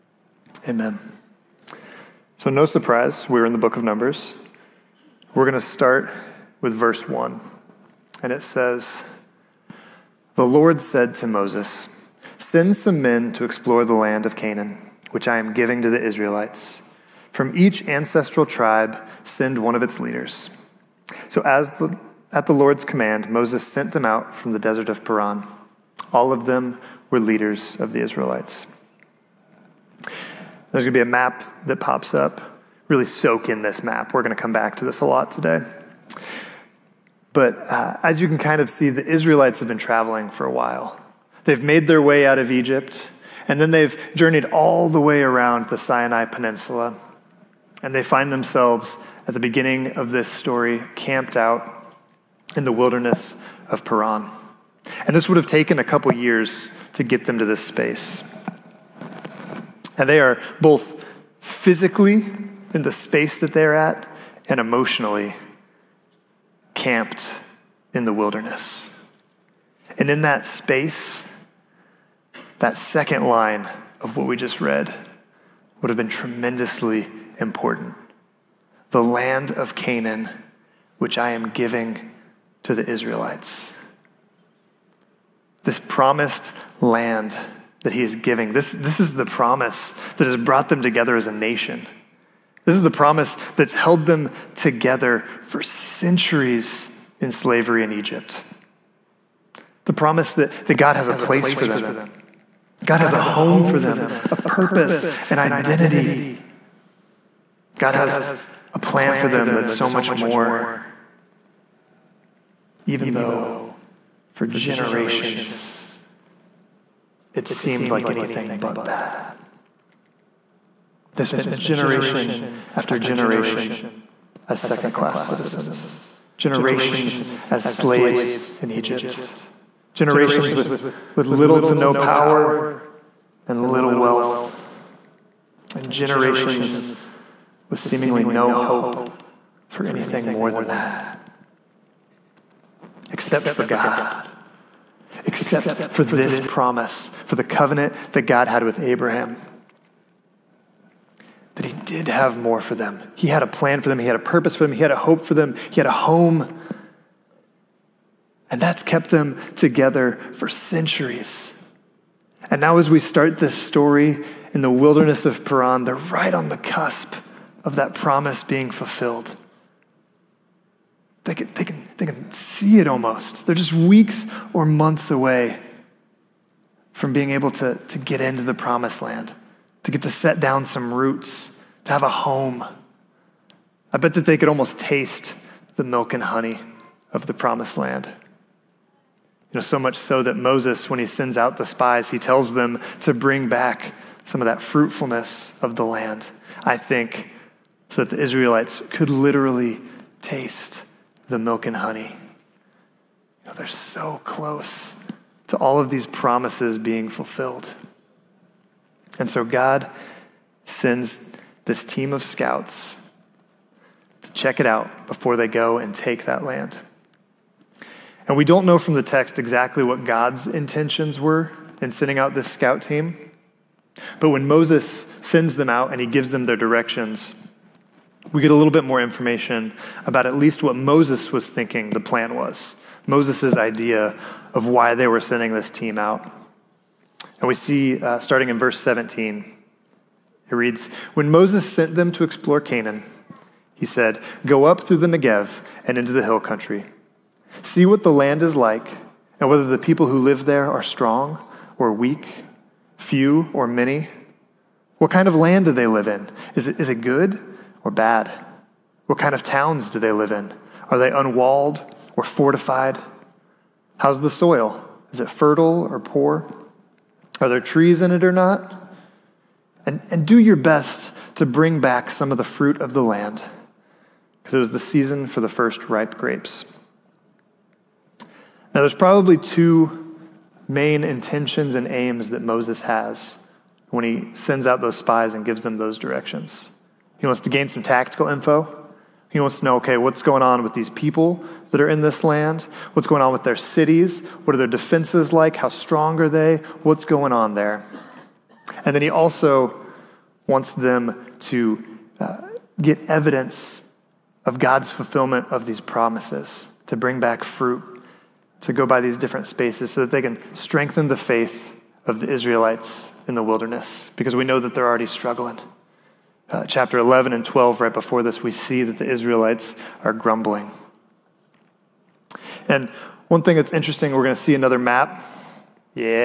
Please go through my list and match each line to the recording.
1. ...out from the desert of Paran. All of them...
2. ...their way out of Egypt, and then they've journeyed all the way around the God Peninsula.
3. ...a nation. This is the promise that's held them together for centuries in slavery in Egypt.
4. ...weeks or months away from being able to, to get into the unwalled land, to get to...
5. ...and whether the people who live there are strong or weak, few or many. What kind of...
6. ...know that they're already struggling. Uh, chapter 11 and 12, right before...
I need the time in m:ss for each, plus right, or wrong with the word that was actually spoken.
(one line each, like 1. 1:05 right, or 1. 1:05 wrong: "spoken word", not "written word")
1. 0:24 right
2. 0:41 wrong: "Sinai", not "God"
3. 1:31 right
4. 2:53 wrong: "promised", not "unwalled"
5. 4:09 right
6. 5:14 right.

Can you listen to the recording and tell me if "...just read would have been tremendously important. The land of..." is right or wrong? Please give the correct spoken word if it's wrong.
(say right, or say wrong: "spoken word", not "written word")
right.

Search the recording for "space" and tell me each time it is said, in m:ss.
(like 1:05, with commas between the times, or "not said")
0:57, 1:02, 1:10, 5:09.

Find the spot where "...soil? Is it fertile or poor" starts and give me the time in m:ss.
4:24.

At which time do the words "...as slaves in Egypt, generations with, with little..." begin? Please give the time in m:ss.
2:07.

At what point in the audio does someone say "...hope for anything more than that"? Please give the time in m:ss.
2:18.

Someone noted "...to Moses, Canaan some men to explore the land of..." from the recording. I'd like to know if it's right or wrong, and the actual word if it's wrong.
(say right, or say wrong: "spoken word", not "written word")
wrong: "Send", not "Canaan".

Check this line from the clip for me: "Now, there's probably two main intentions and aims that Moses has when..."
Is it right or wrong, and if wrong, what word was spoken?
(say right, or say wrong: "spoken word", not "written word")
right.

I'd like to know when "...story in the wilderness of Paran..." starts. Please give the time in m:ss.
2:43.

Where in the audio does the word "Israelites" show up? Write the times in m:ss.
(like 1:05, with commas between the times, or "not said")
0:16, 0:27, 0:39, 1:22, 3:18, 5:12, 5:19.